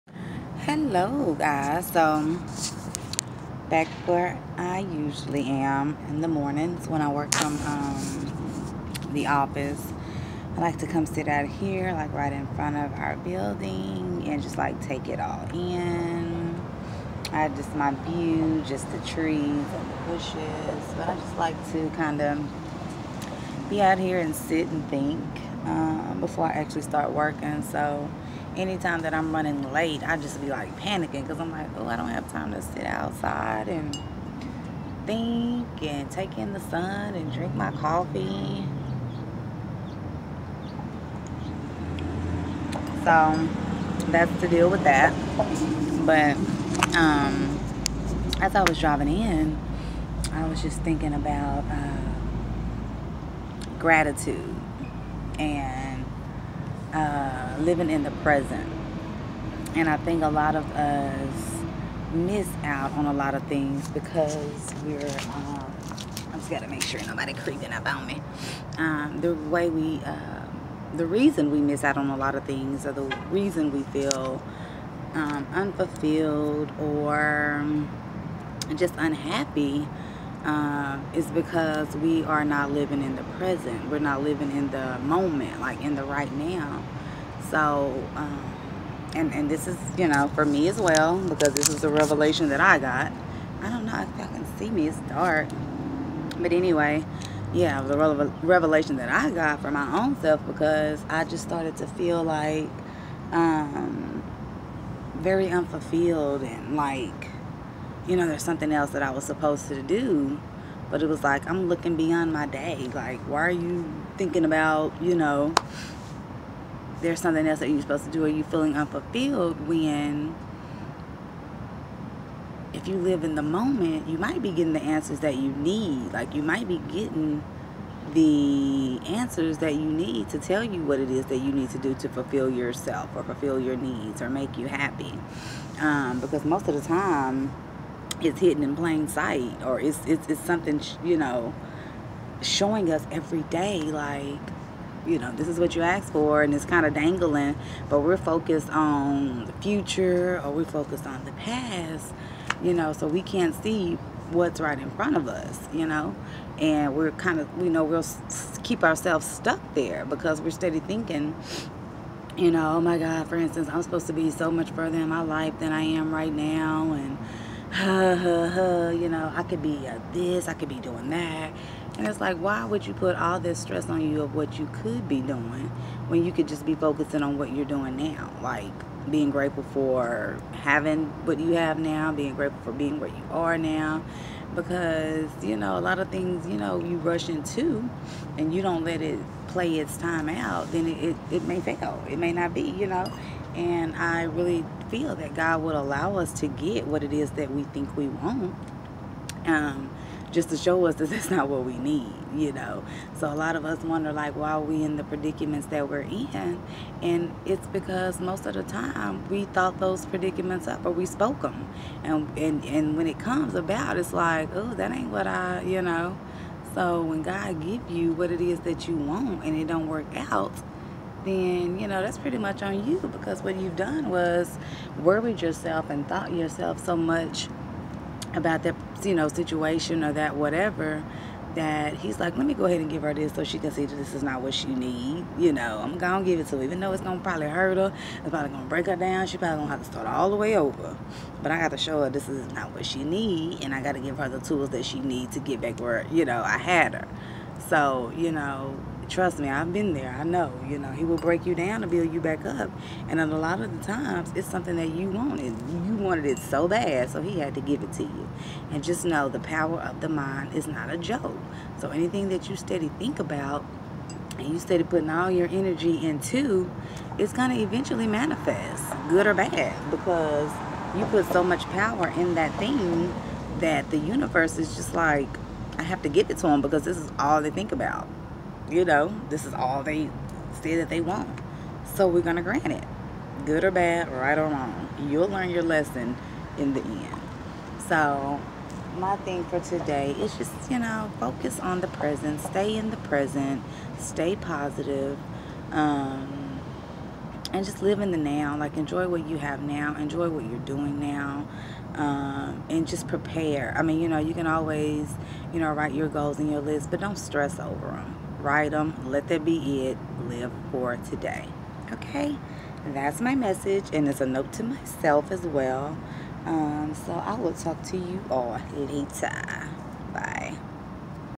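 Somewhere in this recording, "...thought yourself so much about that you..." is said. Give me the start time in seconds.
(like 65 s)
226 s.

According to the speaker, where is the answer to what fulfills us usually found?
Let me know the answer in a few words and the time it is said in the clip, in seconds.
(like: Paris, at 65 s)
Hidden in plain sight, at 138 s.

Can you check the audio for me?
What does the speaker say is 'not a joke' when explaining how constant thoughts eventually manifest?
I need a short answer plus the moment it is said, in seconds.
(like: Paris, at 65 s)
The power of the mind, at 259 s.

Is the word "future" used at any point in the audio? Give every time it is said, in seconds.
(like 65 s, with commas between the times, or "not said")
149 s.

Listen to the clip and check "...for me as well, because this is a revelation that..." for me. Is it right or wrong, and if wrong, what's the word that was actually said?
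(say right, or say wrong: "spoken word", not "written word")
right.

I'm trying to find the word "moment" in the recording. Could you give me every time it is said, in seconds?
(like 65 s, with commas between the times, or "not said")
84 s, 123 s.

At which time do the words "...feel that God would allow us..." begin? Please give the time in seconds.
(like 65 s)
194 s.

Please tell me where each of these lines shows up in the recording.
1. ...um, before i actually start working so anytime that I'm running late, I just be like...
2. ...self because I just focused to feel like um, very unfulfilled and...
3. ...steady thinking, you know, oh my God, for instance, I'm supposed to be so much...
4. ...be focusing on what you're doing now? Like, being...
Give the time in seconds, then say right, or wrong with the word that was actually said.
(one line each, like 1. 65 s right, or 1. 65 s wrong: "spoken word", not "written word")
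1. 25 s right
2. 100 s wrong: "started", not "focused"
3. 160 s right
4. 176 s right.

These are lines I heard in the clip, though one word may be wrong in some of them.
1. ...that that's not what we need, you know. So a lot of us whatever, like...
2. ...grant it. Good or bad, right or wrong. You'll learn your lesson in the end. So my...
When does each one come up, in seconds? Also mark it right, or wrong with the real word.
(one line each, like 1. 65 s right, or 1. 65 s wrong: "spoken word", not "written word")
1. 200 s wrong: "wonder", not "whatever"
2. 282 s right.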